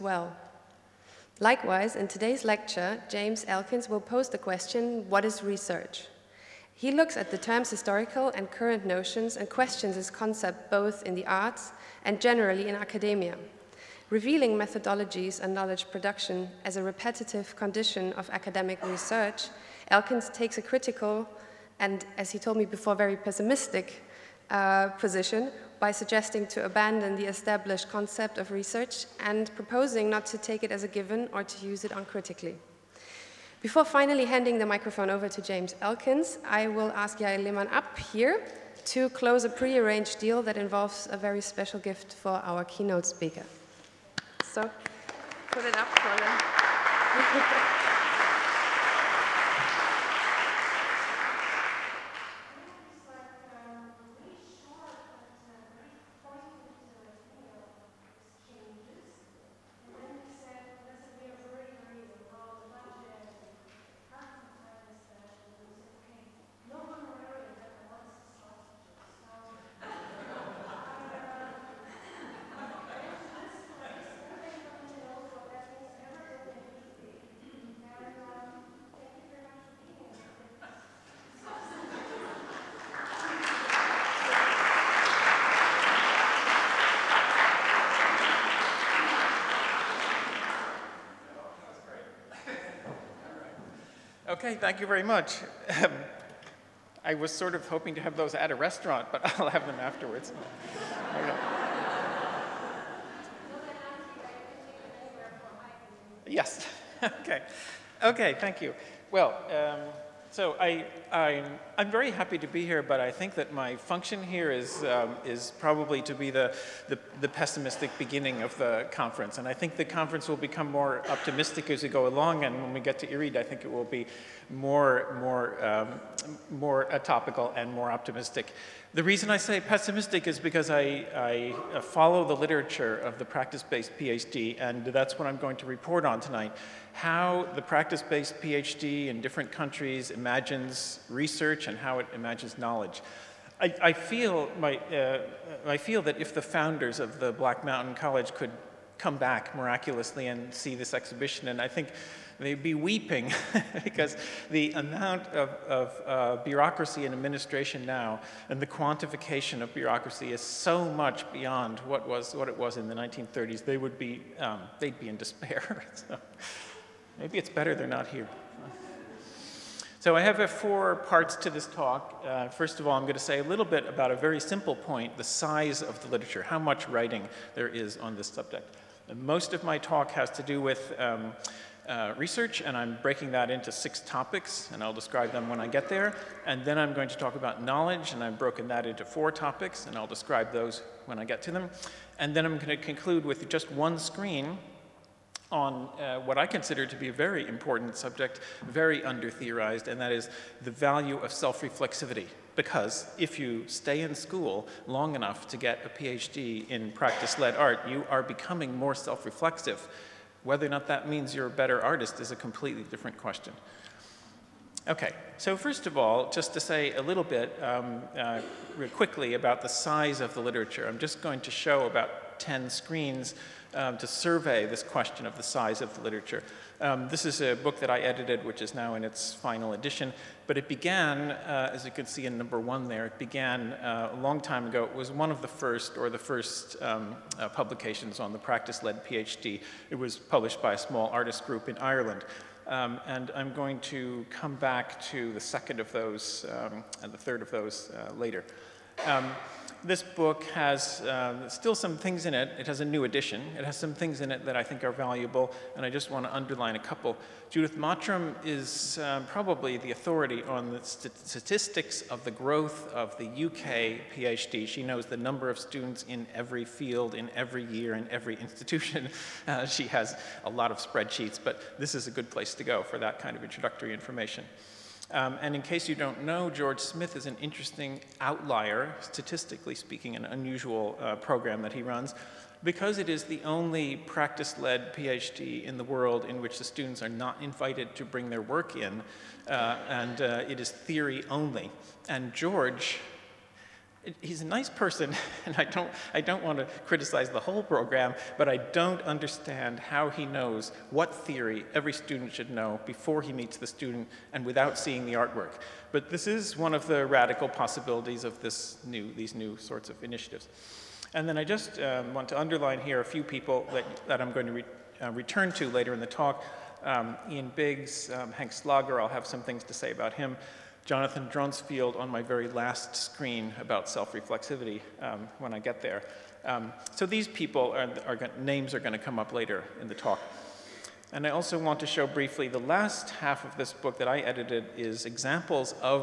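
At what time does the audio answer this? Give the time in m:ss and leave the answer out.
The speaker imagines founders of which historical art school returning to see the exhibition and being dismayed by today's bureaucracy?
2:27.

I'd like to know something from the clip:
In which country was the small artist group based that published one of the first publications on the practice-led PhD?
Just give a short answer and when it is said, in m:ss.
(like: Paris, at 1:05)
Ireland, at 4:01.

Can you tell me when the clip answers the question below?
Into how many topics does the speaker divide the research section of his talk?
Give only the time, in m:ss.
3:03.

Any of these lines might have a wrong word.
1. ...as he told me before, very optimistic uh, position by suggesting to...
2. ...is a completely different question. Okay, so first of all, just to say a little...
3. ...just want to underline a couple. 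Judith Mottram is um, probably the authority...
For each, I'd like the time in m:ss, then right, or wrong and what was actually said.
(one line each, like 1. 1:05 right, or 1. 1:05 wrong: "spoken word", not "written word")
1. 0:22 wrong: "pessimistic", not "optimistic"
2. 3:32 right
3. 4:15 right.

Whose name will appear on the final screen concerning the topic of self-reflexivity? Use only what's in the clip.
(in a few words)
Jonathan Dronsfield.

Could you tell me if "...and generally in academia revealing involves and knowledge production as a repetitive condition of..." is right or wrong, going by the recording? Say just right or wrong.
wrong.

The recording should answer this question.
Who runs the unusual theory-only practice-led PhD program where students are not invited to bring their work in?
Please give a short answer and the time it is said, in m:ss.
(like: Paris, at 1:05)
George Smith, at 4:36.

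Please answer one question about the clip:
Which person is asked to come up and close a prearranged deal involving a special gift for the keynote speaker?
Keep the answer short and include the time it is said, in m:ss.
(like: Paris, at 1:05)
Yael Lehmann, at 0:37.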